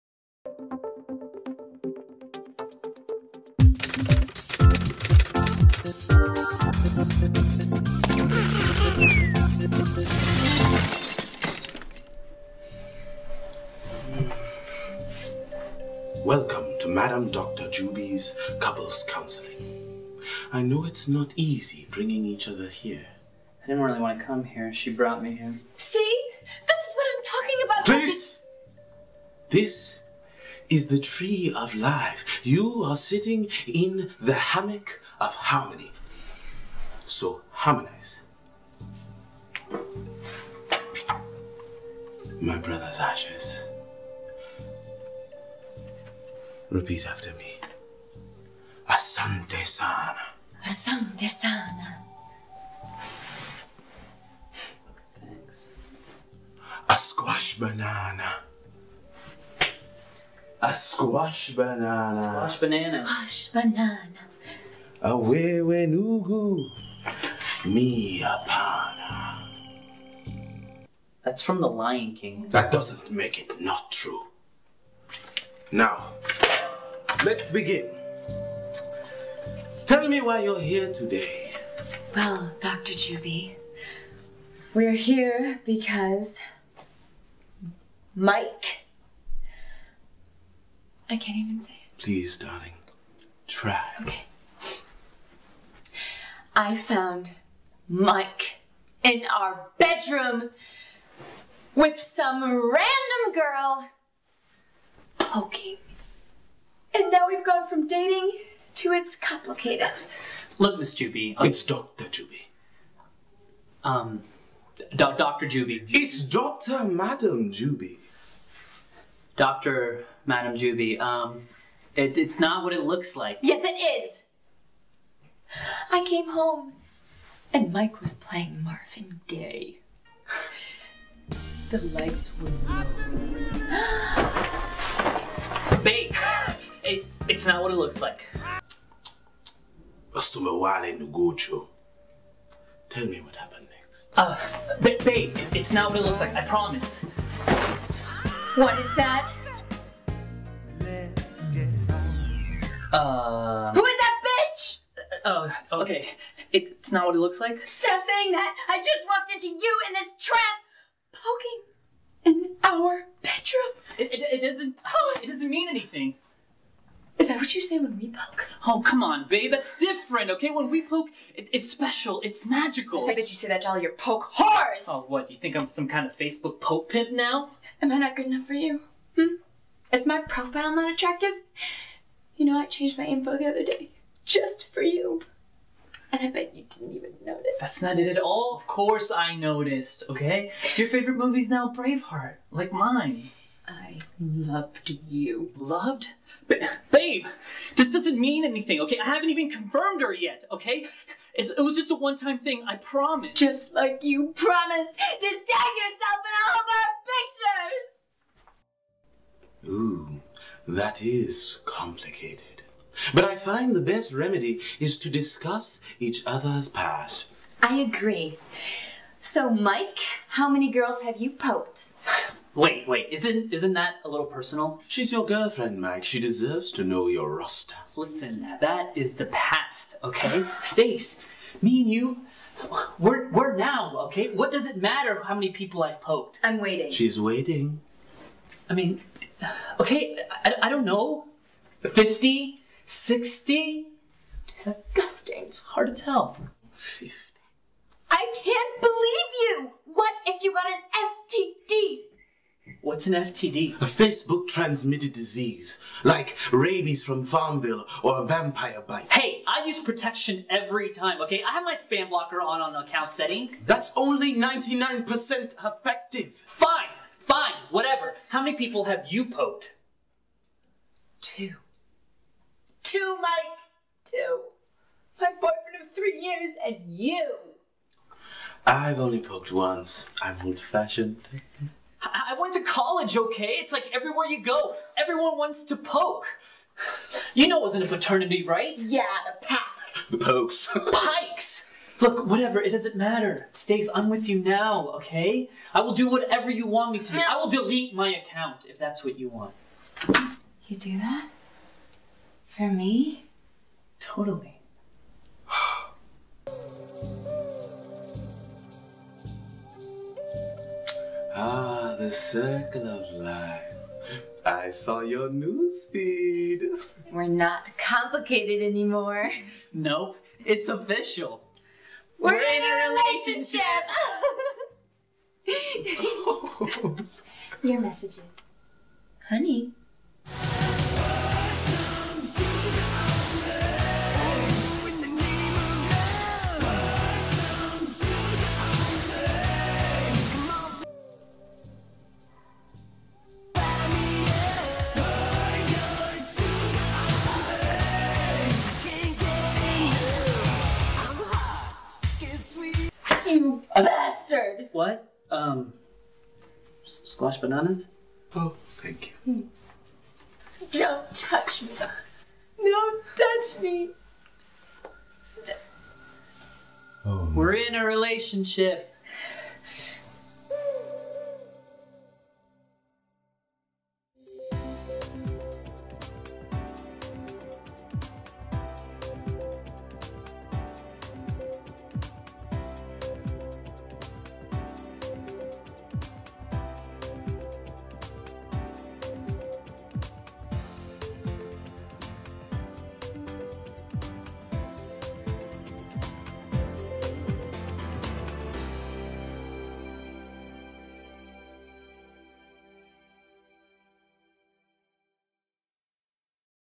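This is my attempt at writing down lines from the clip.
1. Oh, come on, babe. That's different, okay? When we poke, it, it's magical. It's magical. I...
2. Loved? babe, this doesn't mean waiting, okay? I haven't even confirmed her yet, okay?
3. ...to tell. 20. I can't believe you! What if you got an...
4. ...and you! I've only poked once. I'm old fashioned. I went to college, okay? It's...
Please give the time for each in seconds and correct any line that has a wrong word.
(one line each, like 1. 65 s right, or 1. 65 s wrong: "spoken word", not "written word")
1. 168 s wrong: "special", not "magical"
2. 195 s wrong: "anything", not "waiting"
3. 245 s wrong: "50", not "20"
4. 276 s right.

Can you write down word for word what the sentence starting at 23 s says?
I didn't really want to come here.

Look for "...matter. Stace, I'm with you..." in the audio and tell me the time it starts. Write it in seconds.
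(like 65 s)
292 s.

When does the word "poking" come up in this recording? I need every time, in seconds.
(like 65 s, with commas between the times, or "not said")
105 s, 161 s.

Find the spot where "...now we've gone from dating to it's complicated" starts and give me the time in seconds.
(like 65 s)
107 s.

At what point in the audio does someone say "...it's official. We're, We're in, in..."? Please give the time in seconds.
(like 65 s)
320 s.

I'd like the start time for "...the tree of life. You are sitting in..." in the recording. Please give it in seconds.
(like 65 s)
30 s.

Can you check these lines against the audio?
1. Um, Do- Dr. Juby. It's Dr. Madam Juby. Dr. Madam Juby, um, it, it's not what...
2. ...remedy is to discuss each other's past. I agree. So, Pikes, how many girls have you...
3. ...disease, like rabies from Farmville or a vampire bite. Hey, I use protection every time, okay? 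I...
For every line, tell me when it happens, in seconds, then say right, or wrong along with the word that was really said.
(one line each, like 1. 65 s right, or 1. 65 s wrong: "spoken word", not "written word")
1. 113 s right
2. 214 s wrong: "Mike", not "Pikes"
3. 255 s right.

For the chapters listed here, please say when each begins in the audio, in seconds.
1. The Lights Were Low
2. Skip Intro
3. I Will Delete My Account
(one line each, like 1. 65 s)
1. 133 s
2. 12 s
3. 292 s.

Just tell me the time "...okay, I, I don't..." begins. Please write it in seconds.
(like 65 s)
239 s.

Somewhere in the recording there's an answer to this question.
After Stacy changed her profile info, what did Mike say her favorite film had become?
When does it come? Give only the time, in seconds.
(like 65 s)
191 s.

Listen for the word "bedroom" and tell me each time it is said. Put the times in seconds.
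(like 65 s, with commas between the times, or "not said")
99 s, 163 s.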